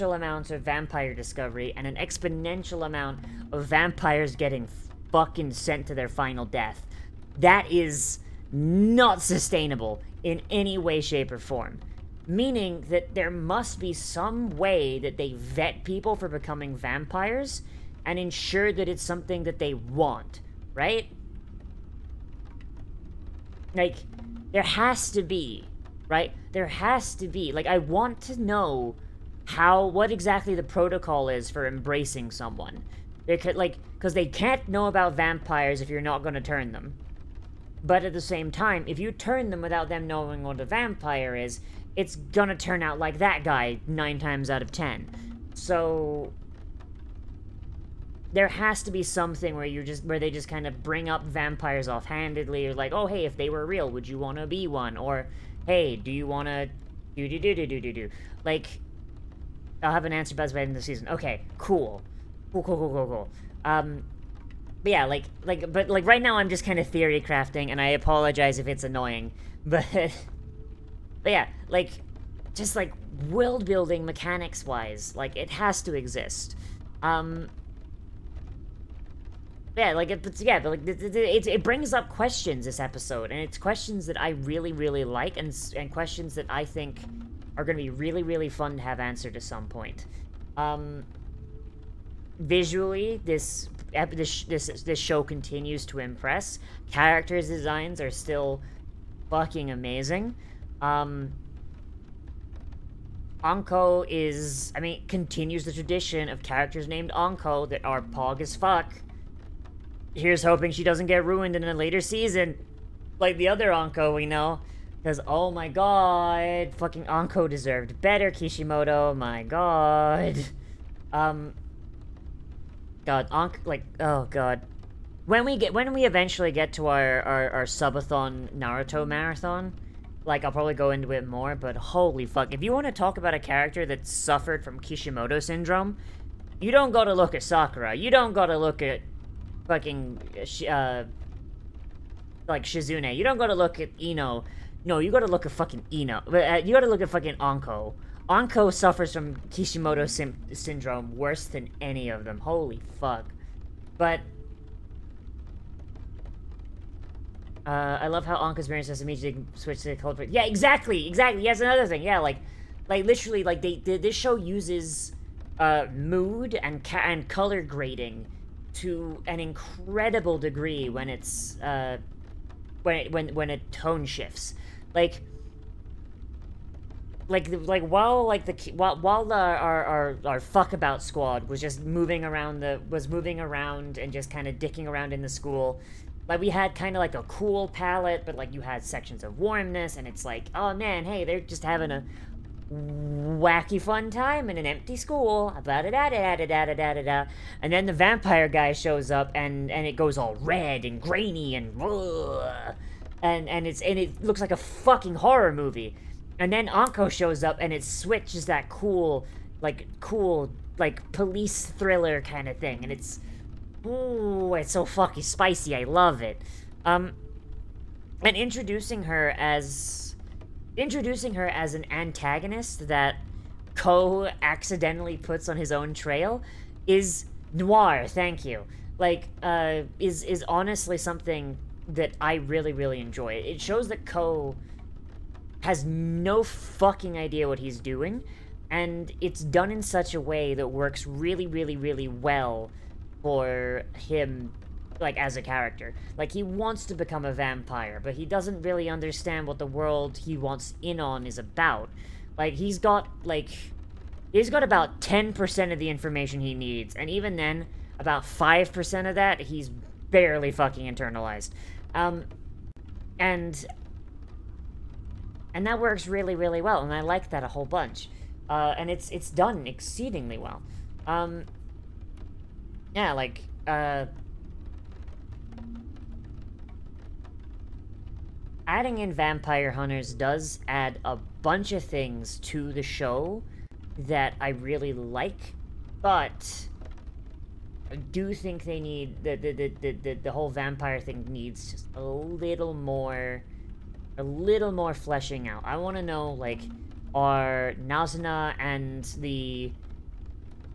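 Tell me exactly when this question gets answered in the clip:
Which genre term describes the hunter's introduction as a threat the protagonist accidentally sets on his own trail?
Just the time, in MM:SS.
03:47.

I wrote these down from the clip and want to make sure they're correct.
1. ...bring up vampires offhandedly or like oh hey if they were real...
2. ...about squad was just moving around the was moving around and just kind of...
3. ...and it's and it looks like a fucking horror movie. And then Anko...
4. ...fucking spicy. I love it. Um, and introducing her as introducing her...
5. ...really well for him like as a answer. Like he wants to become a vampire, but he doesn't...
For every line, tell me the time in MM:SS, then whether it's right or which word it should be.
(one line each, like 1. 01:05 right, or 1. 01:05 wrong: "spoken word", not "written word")
1. 00:50 right
2. 03:00 right
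3. 03:23 right
4. 03:34 right
5. 04:01 wrong: "character", not "answer".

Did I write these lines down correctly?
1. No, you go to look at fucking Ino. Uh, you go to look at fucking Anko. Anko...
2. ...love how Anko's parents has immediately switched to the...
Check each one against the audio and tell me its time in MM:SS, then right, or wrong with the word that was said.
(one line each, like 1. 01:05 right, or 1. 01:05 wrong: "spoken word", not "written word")
1. 02:24 right
2. 02:38 right.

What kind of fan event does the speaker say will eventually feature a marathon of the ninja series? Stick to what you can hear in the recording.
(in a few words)
Subathon.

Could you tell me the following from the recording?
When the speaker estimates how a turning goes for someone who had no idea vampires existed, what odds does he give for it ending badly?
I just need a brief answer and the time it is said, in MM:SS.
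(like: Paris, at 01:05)
9 out of 10, at 00:43.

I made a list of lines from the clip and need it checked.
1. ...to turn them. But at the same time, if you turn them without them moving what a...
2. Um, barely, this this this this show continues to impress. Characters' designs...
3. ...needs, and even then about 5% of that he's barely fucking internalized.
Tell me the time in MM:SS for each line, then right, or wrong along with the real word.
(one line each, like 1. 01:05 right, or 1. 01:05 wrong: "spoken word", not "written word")
1. 00:36 wrong: "knowing", not "moving"
2. 01:30 wrong: "visually", not "barely"
3. 04:16 right.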